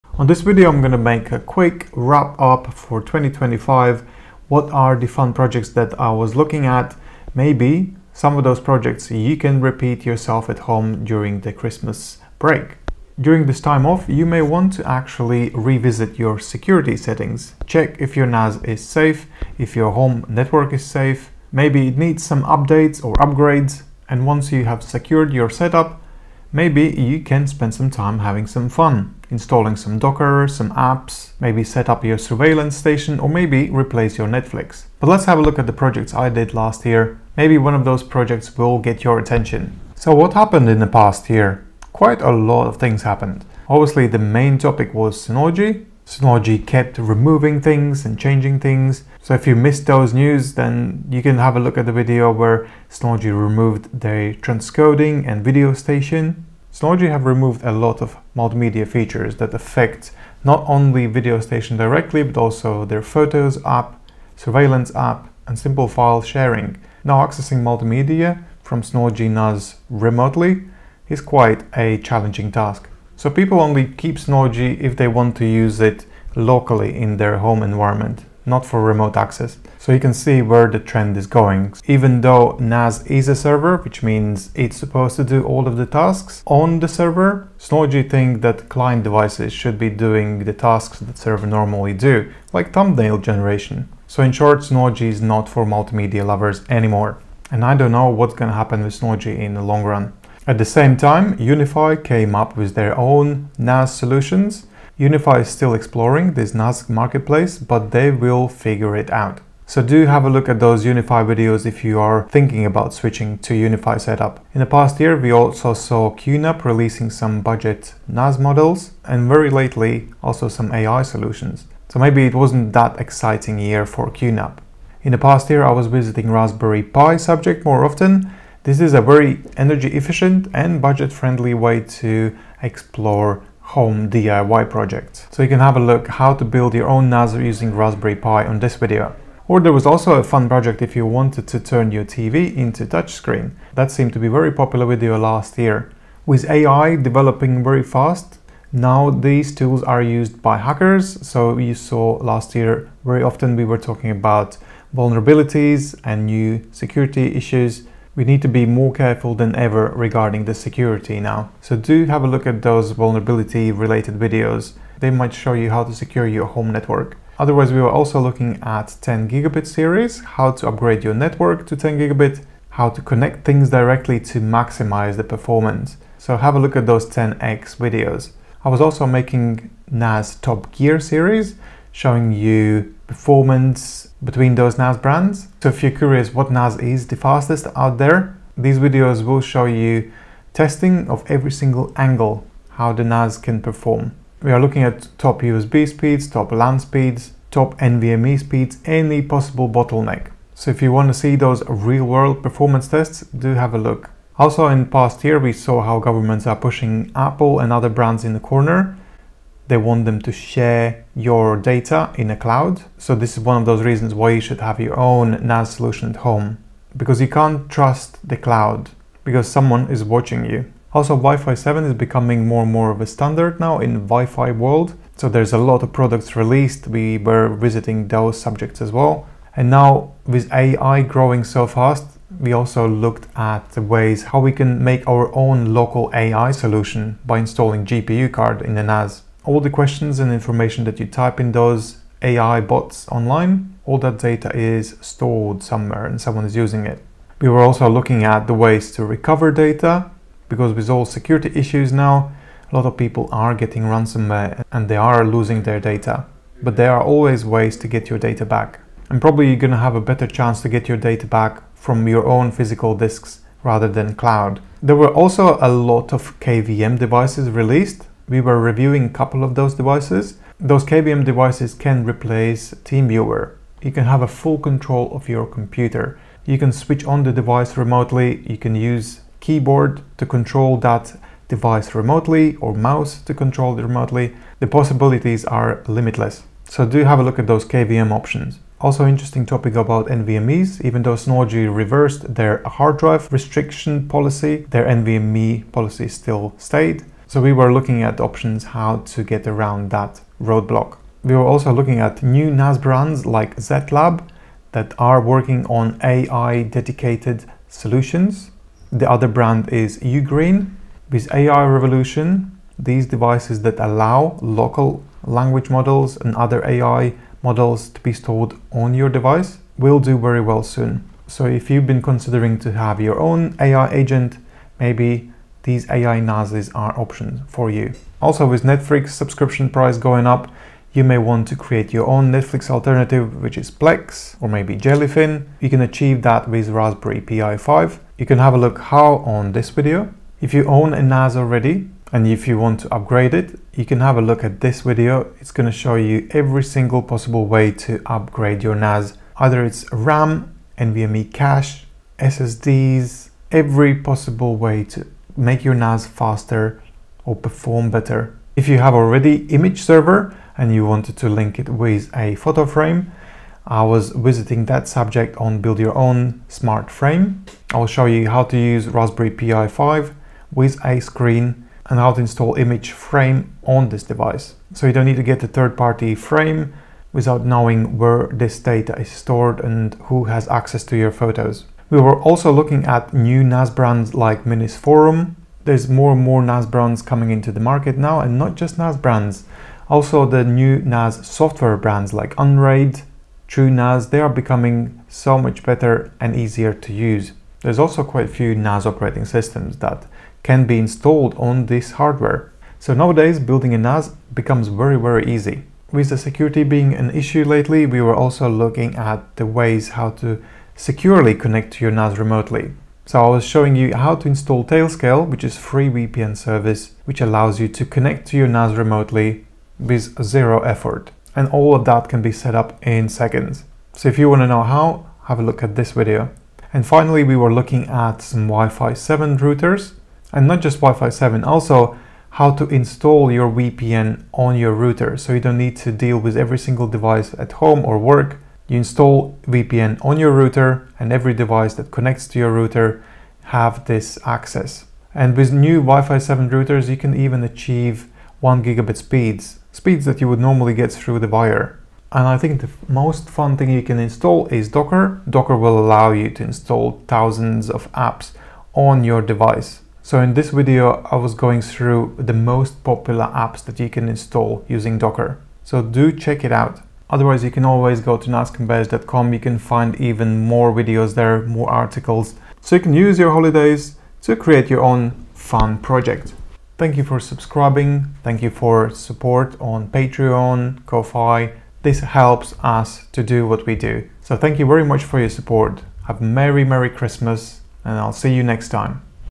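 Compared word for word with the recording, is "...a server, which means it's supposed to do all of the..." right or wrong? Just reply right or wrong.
right.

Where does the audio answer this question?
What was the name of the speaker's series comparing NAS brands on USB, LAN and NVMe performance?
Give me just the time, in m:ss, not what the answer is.
2:59.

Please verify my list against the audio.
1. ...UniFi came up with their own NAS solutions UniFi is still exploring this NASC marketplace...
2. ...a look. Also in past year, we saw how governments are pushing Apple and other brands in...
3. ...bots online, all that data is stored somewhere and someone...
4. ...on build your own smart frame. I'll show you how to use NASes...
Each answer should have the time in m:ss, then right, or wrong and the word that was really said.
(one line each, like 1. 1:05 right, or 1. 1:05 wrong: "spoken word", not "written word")
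1. 1:41 right
2. 3:23 right
3. 4:02 right
4. 6:05 wrong: "Raspberry", not "NASes".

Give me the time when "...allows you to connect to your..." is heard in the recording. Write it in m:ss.
6:57.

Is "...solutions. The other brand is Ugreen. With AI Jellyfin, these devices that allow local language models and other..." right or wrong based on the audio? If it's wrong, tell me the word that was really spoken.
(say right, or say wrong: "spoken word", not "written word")
wrong: "Revolution", not "Jellyfin".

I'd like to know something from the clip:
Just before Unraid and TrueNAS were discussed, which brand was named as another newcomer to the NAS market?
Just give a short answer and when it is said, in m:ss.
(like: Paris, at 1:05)
Minisforum, at 6:24.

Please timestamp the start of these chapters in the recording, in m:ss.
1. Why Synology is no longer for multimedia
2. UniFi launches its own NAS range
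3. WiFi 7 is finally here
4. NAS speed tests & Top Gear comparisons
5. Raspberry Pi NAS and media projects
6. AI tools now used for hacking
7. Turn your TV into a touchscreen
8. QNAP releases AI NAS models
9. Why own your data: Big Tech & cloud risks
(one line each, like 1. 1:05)
1. 0:52
2. 1:37
3. 3:48
4. 2:58
5. 2:09
6. 2:42
7. 2:25
8. 1:52
9. 3:33.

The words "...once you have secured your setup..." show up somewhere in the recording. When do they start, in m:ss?
0:24.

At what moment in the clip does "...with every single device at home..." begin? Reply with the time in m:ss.
7:16.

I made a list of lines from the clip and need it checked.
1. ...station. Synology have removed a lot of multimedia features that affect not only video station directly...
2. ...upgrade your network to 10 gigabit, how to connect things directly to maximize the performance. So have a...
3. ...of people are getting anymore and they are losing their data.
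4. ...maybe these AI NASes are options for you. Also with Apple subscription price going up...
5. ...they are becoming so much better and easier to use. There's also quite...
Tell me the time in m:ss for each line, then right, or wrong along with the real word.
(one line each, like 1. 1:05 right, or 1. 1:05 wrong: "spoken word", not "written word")
1. 0:55 right
2. 2:50 right
3. 4:12 wrong: "ransomware", not "anymore"
4. 5:24 wrong: "Netflix", not "Apple"
5. 6:34 right.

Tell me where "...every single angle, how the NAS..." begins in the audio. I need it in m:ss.
3:11.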